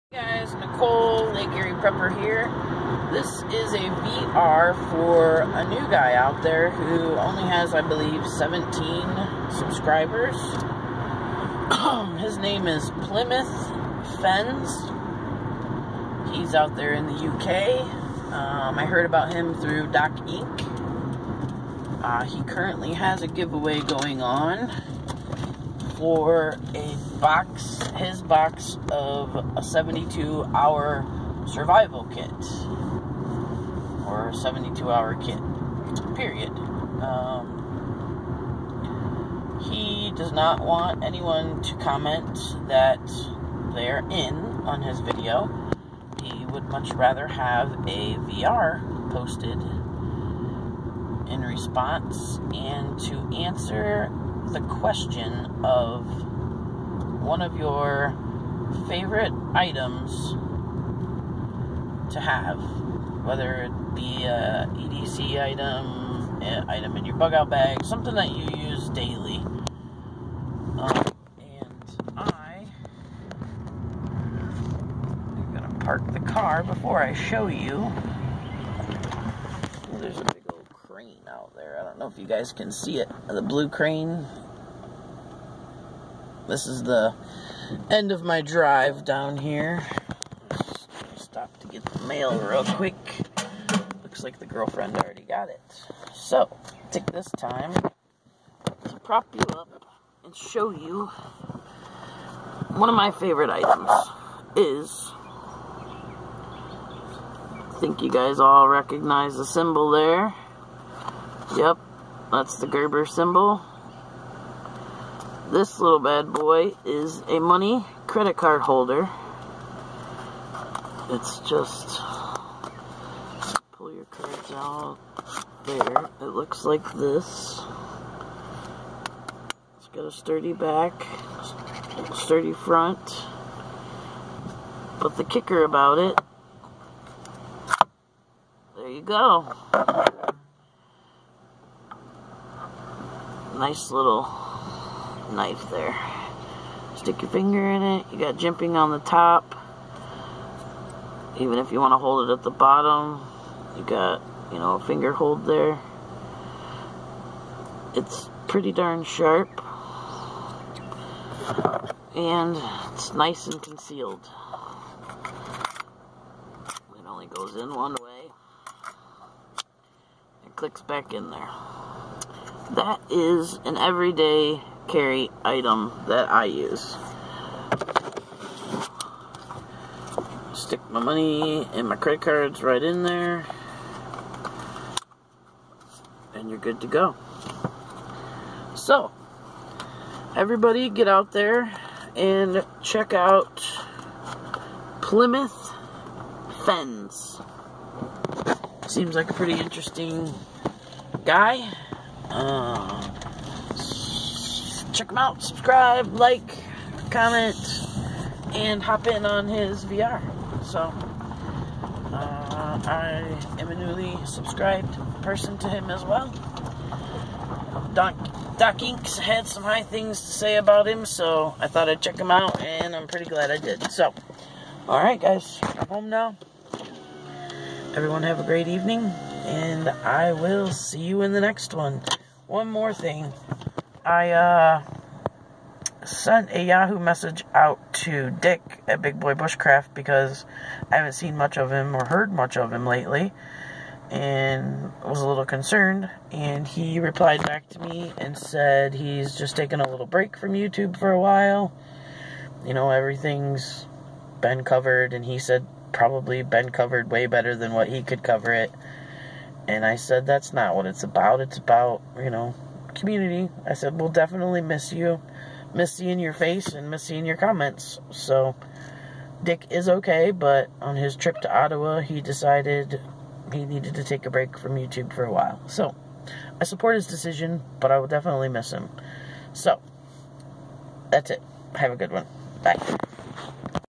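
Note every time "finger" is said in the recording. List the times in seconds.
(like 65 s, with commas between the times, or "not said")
147 s, 154 s.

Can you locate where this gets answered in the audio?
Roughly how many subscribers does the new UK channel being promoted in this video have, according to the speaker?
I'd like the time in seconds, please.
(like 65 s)
8 s.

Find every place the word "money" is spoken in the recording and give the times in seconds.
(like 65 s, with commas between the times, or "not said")
117 s, 181 s.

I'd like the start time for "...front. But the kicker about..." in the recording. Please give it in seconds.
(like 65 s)
132 s.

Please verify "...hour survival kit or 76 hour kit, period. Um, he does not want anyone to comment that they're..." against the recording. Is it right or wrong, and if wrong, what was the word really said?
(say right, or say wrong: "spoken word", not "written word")
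wrong: "72", not "76".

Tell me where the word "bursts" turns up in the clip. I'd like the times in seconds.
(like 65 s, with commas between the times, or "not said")
not said.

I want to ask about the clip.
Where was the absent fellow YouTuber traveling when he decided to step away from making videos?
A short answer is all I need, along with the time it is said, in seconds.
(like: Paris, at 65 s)
Ottawa, at 271 s.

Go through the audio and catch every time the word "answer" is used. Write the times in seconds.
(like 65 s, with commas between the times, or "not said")
53 s.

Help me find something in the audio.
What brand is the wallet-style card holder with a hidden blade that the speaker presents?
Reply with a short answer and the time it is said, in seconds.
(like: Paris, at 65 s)
Gerber, at 112 s.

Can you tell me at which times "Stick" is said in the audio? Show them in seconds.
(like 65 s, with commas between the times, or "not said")
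146 s, 180 s.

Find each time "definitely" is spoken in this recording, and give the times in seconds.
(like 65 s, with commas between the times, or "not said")
264 s, 278 s.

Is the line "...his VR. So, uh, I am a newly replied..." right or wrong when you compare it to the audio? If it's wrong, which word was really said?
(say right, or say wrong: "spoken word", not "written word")
wrong: "subscribed", not "replied".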